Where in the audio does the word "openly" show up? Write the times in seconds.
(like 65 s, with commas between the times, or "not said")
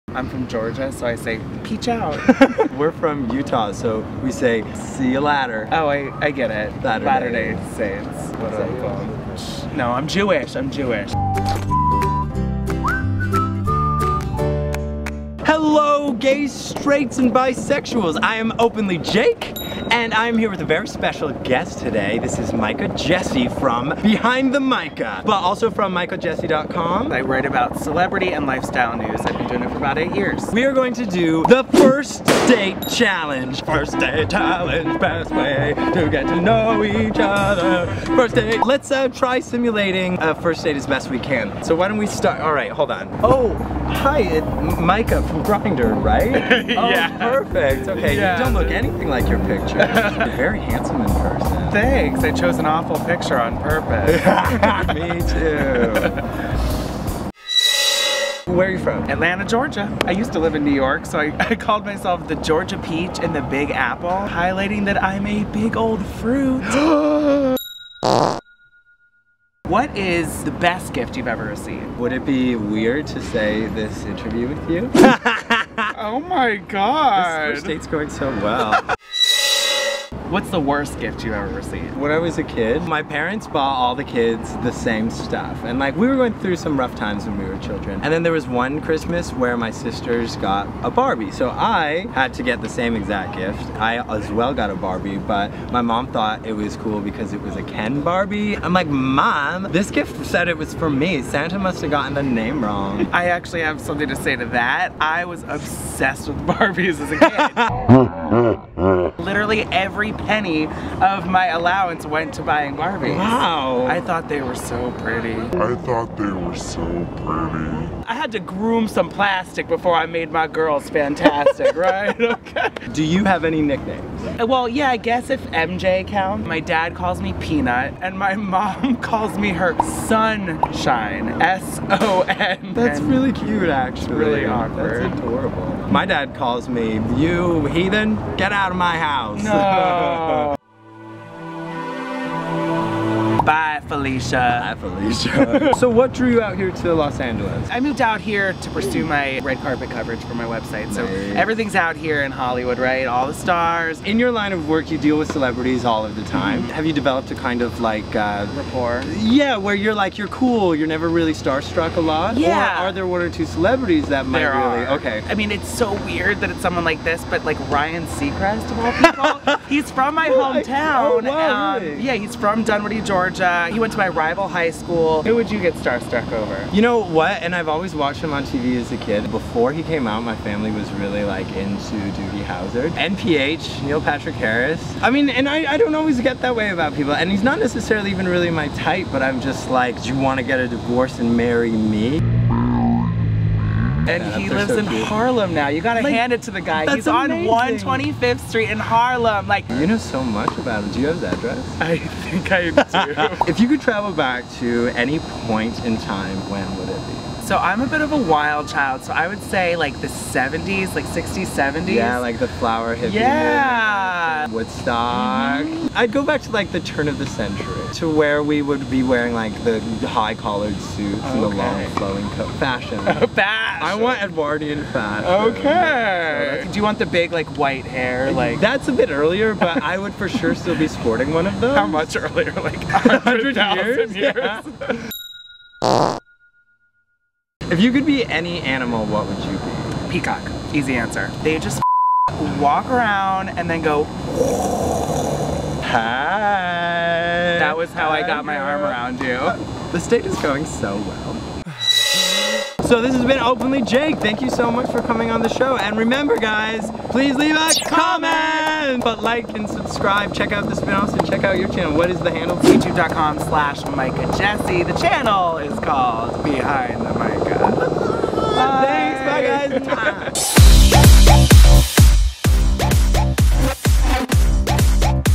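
18 s, 253 s.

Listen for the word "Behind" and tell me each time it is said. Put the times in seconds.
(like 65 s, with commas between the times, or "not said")
24 s, 266 s.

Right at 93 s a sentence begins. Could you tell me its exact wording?
I as well got a Barbie, but my mom thought it was cool because it was a Ken Barbie.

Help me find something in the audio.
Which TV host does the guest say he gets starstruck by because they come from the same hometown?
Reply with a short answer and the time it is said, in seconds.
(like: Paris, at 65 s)
Ryan Seacrest, at 167 s.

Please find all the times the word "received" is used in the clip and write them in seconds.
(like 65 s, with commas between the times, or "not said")
71 s, 81 s.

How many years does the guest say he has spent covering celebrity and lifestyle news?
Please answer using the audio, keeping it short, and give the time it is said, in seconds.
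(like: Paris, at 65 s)
8 years, at 29 s.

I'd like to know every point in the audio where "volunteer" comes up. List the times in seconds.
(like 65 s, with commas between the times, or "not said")
not said.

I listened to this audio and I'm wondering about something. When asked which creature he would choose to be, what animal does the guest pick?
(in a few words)
Peacock.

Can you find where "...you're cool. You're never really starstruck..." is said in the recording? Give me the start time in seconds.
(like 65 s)
160 s.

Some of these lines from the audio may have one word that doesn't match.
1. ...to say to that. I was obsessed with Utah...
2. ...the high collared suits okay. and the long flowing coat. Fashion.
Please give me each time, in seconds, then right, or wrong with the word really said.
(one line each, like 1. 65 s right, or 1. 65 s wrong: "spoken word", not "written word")
1. 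104 s wrong: "Barbies", not "Utah"
2. 219 s right.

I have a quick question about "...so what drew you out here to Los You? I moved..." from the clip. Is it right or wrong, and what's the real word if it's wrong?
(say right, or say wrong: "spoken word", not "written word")
wrong: "Angeles", not "You".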